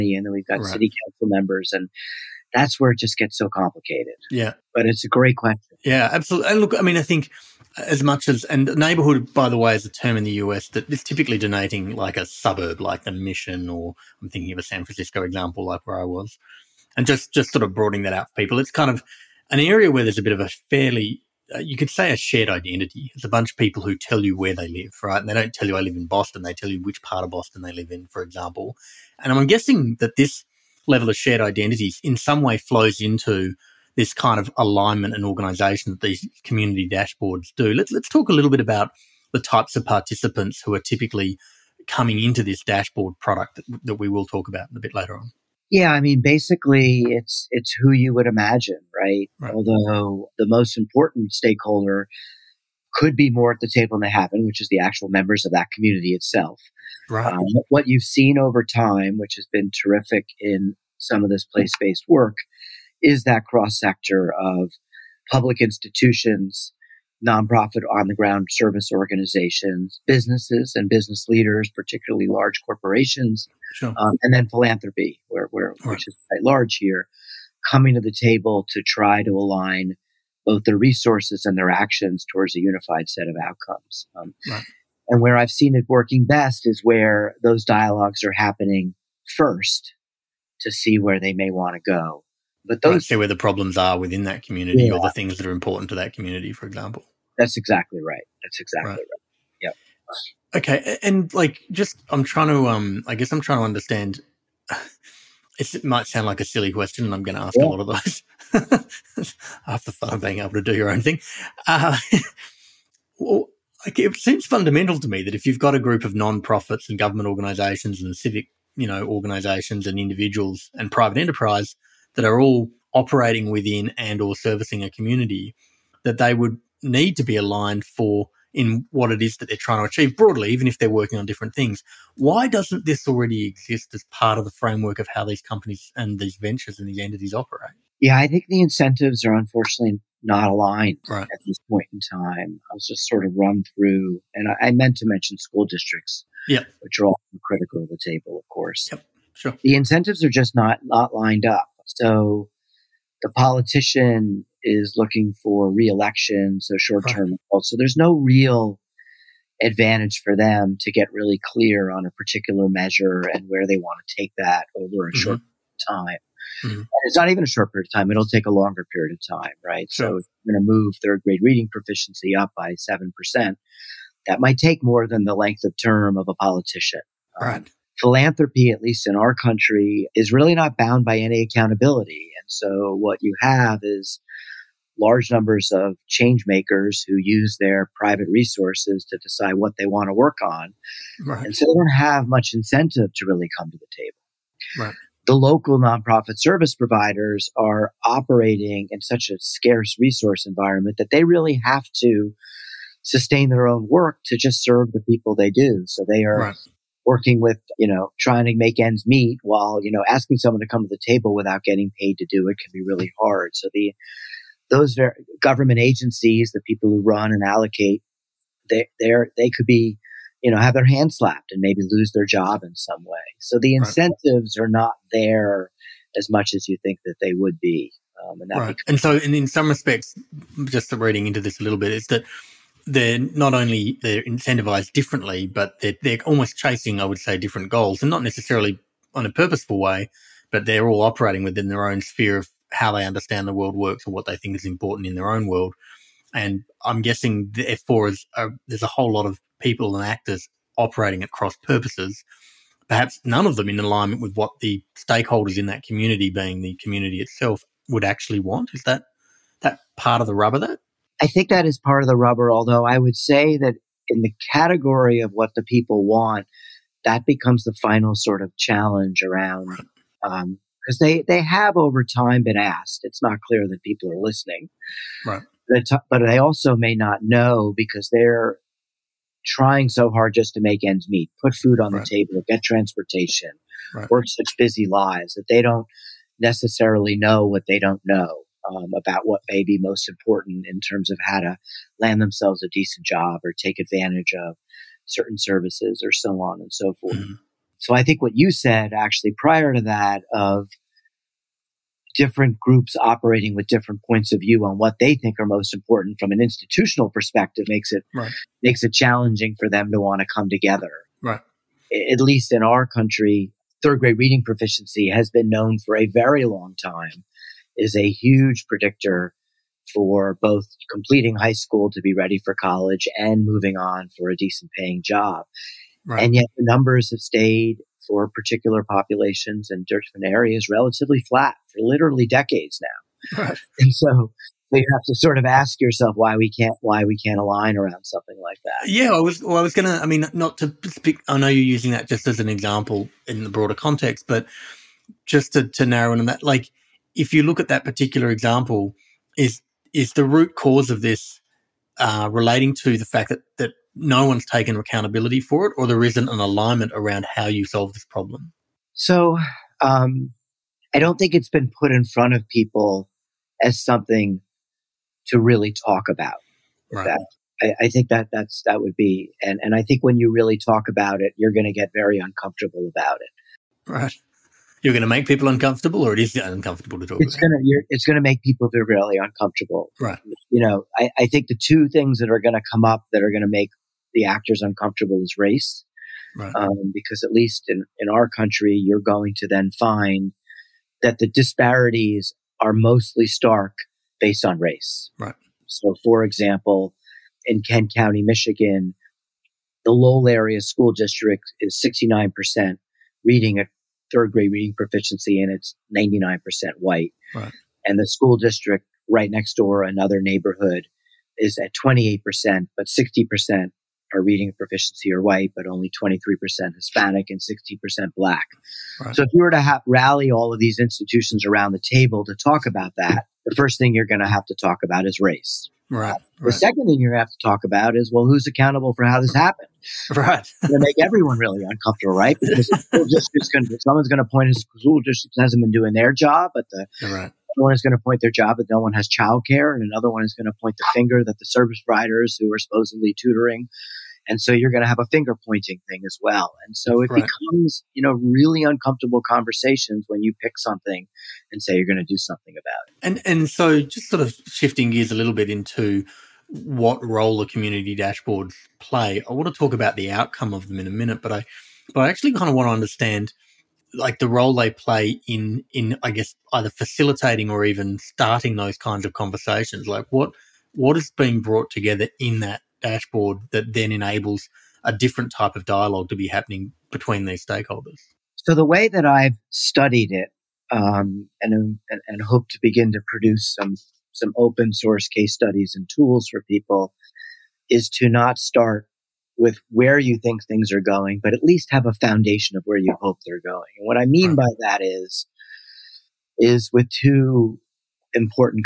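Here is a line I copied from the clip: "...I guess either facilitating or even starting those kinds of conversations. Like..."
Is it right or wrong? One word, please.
right.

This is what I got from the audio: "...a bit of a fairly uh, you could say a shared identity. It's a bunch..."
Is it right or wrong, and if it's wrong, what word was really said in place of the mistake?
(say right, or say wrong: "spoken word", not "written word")
right.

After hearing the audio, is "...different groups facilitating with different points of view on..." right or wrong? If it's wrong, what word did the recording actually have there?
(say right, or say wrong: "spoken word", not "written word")
wrong: "operating", not "facilitating".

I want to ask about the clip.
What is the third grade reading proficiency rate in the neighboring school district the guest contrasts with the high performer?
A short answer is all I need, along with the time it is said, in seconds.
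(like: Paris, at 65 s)
28%, at 411 s.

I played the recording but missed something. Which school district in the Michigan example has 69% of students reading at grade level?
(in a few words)
Lowell area school district.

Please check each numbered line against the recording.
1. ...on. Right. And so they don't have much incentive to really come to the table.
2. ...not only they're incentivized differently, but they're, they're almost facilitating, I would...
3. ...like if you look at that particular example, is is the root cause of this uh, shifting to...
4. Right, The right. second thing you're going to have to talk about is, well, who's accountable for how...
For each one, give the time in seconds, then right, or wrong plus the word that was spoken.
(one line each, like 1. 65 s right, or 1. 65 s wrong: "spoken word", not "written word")
1. 190 s right
2. 233 s wrong: "chasing", not "facilitating"
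3. 346 s wrong: "relating", not "shifting"
4. 425 s right.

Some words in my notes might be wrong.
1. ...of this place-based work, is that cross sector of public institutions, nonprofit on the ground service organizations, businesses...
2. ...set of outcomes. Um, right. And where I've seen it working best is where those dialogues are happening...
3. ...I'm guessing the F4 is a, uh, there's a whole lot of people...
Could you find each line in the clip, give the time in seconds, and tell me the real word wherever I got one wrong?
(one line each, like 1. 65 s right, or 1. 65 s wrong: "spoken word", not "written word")
1. 61 s right
2. 83 s right
3. 246 s right.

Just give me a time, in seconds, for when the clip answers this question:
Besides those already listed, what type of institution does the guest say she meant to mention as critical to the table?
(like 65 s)
145 s.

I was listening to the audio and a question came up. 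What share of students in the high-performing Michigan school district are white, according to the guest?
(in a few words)
99%.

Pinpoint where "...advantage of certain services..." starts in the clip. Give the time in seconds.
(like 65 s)
293 s.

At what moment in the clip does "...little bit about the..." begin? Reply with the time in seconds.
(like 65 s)
38 s.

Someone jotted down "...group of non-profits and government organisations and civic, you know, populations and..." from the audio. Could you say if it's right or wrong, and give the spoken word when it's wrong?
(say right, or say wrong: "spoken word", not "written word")
wrong: "organisations", not "populations".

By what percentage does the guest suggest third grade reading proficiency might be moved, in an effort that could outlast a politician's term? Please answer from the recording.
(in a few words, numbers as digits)
7%.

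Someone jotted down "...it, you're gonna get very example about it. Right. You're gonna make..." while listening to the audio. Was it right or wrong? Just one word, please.
wrong.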